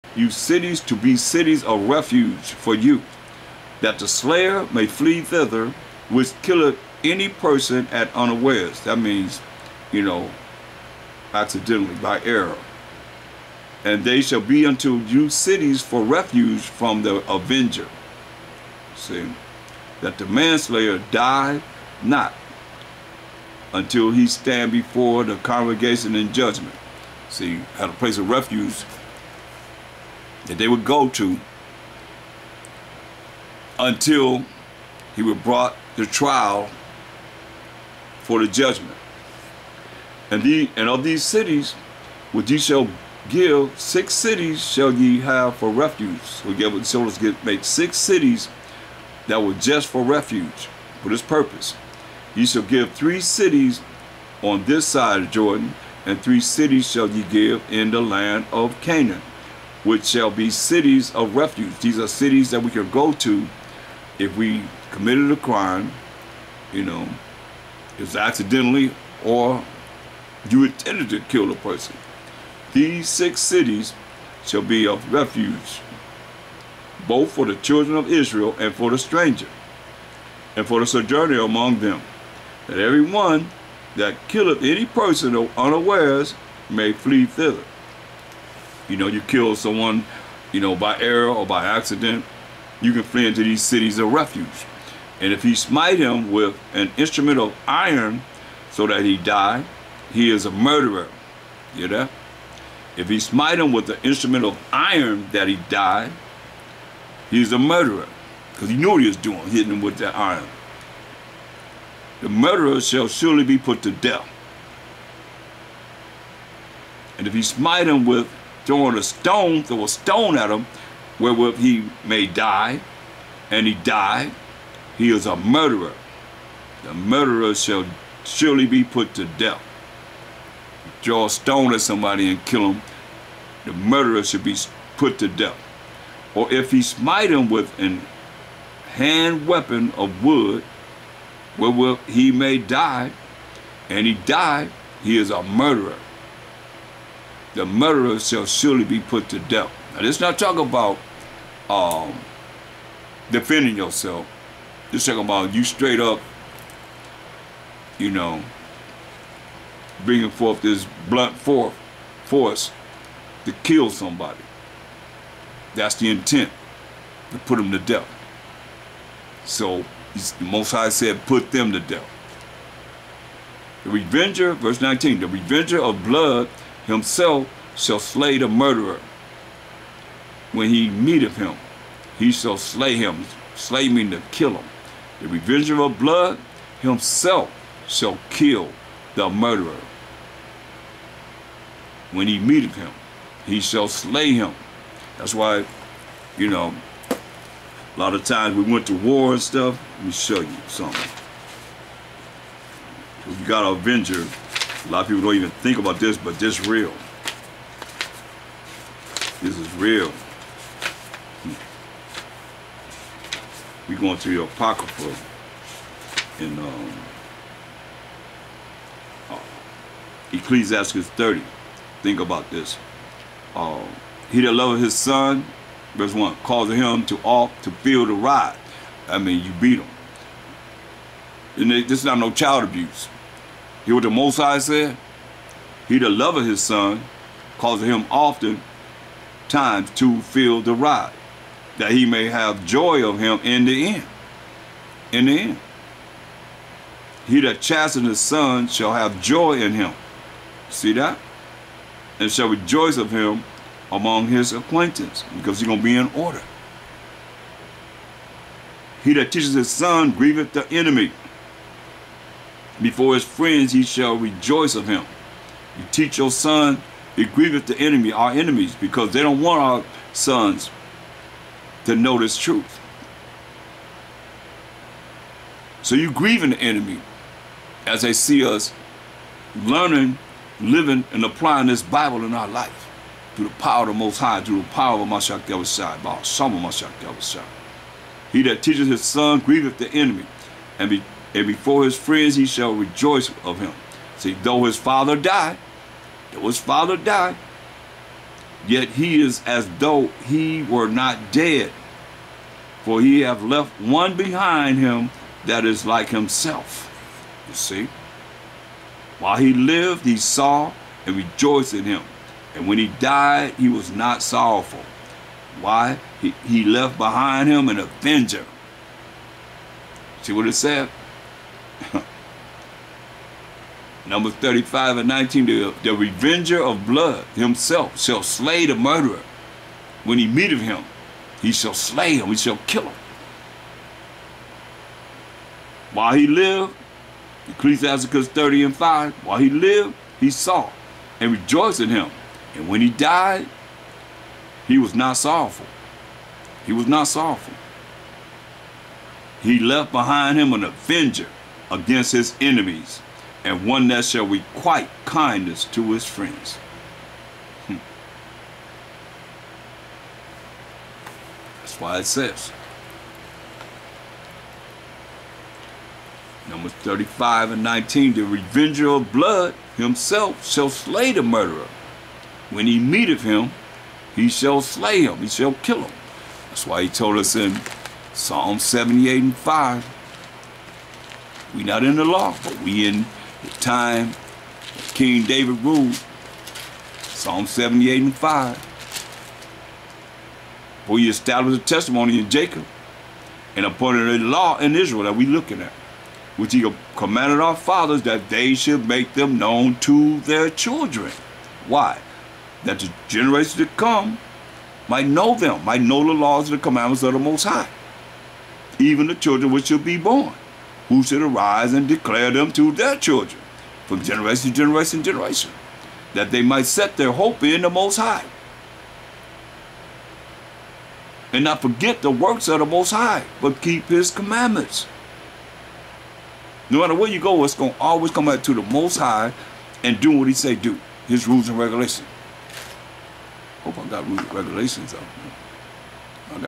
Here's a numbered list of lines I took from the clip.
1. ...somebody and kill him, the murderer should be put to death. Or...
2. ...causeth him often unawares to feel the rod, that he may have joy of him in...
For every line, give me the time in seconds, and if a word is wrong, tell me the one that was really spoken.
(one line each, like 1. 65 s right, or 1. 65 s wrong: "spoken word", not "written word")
1. 131 s right
2. 237 s wrong: "times", not "unawares".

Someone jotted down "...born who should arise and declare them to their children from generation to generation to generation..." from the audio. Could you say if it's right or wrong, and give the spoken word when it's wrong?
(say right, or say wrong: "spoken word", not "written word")
right.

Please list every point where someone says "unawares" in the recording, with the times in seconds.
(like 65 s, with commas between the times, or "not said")
8 s, 85 s.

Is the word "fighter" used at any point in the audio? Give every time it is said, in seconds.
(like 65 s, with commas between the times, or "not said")
not said.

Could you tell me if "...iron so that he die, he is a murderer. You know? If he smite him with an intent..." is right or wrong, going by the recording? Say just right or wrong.
wrong.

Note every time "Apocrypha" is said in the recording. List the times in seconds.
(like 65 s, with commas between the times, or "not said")
214 s.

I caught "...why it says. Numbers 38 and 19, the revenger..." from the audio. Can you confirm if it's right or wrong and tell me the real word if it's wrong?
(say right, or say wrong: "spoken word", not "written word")
wrong: "35", not "38".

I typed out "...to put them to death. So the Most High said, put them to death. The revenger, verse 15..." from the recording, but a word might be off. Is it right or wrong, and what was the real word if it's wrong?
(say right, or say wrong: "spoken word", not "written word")
wrong: "19", not "15".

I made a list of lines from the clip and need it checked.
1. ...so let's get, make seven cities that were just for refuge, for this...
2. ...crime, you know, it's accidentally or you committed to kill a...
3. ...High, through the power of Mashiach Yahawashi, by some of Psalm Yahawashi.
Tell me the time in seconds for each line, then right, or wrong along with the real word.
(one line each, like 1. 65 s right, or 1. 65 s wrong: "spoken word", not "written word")
1. 46 s wrong: "six", not "seven"
2. 65 s wrong: "intended", not "committed"
3. 284 s wrong: "Mashiach", not "Psalm".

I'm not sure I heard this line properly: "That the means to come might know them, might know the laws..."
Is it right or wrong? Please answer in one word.
wrong.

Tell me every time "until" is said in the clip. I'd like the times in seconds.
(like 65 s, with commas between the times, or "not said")
23 s, 33 s.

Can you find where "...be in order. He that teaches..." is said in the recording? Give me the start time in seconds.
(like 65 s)
255 s.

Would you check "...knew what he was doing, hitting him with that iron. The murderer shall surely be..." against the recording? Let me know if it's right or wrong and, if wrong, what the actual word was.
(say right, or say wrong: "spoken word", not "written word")
right.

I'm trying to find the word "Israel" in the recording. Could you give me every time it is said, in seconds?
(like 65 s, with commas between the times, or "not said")
78 s, 394 s.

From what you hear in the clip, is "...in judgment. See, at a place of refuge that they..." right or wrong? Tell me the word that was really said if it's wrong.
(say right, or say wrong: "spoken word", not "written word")
right.